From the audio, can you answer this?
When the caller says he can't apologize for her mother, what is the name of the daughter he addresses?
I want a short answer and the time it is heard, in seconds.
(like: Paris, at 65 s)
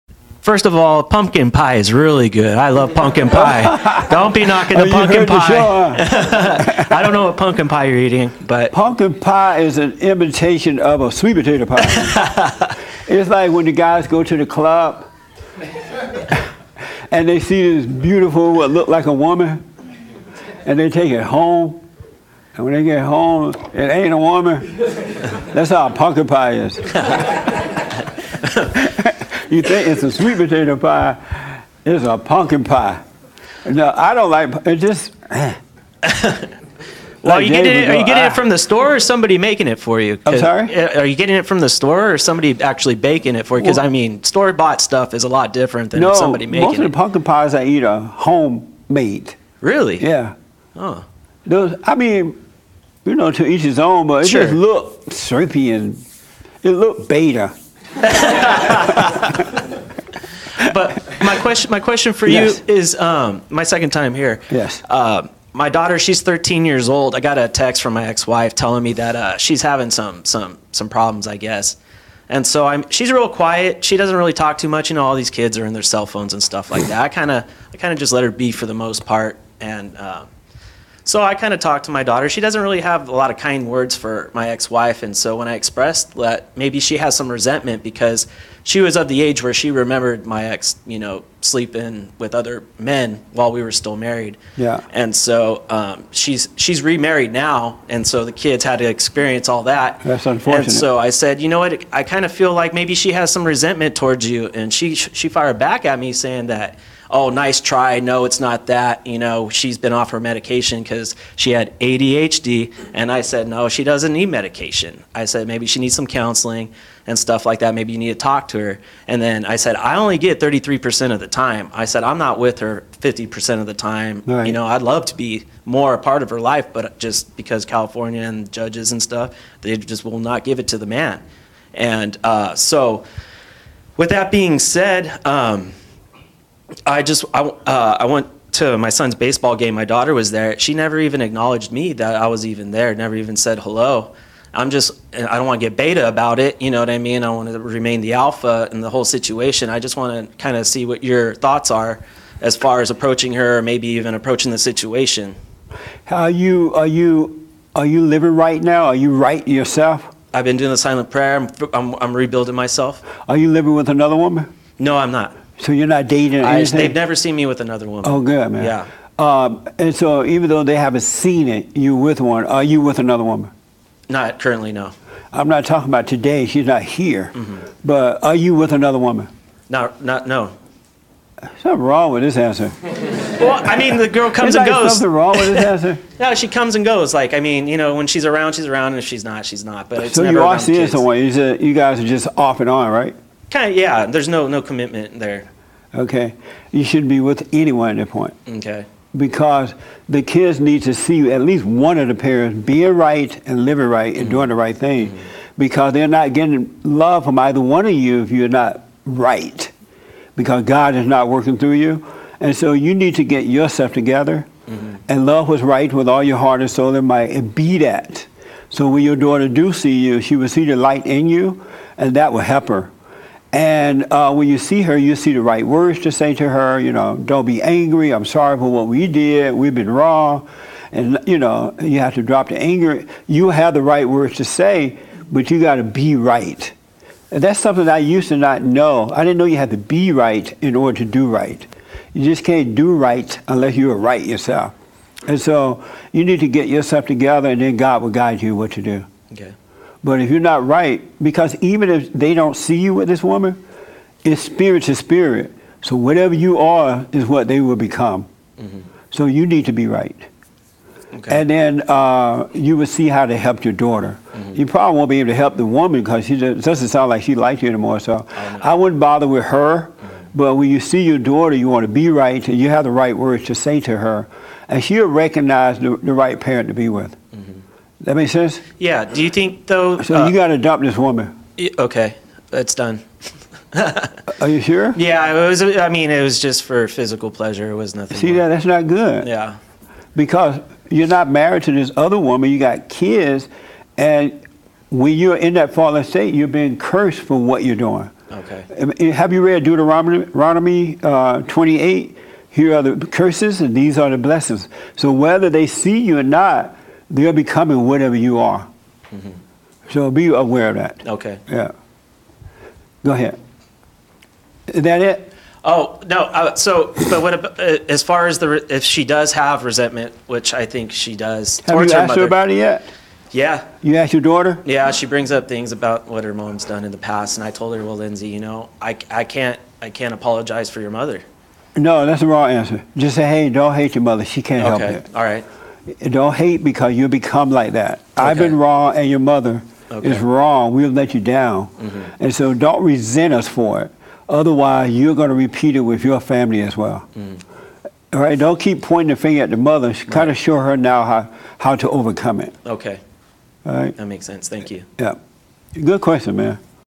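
Lindsay, at 327 s.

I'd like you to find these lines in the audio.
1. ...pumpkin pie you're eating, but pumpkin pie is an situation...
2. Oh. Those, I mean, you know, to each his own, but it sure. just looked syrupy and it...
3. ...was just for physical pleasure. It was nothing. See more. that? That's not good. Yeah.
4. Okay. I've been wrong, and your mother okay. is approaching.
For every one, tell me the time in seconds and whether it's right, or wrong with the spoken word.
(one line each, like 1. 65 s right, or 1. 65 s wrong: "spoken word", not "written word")
1. 7 s wrong: "imitation", not "situation"
2. 50 s right
3. 286 s right
4. 337 s wrong: "wrong", not "approaching".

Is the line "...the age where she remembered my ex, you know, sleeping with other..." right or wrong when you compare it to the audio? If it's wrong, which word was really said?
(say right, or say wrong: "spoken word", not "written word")
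right.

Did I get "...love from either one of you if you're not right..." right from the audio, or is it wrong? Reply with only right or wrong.
right.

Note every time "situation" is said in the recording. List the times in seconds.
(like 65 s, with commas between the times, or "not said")
149 s, 154 s.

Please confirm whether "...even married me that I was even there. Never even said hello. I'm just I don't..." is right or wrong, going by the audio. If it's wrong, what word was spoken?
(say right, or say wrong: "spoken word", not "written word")
wrong: "acknowledged", not "married".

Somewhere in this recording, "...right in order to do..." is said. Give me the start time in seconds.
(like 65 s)
240 s.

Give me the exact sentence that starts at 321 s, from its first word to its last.
Have you her asked mother, her about it yet?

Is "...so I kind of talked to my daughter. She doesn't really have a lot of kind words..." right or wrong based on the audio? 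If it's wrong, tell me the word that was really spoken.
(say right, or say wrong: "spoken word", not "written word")
right.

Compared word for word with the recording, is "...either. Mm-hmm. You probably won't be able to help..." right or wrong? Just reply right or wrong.
wrong.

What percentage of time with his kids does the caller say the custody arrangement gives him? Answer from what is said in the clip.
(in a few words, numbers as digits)
33%.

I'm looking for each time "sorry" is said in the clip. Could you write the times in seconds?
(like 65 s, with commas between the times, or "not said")
40 s, 228 s.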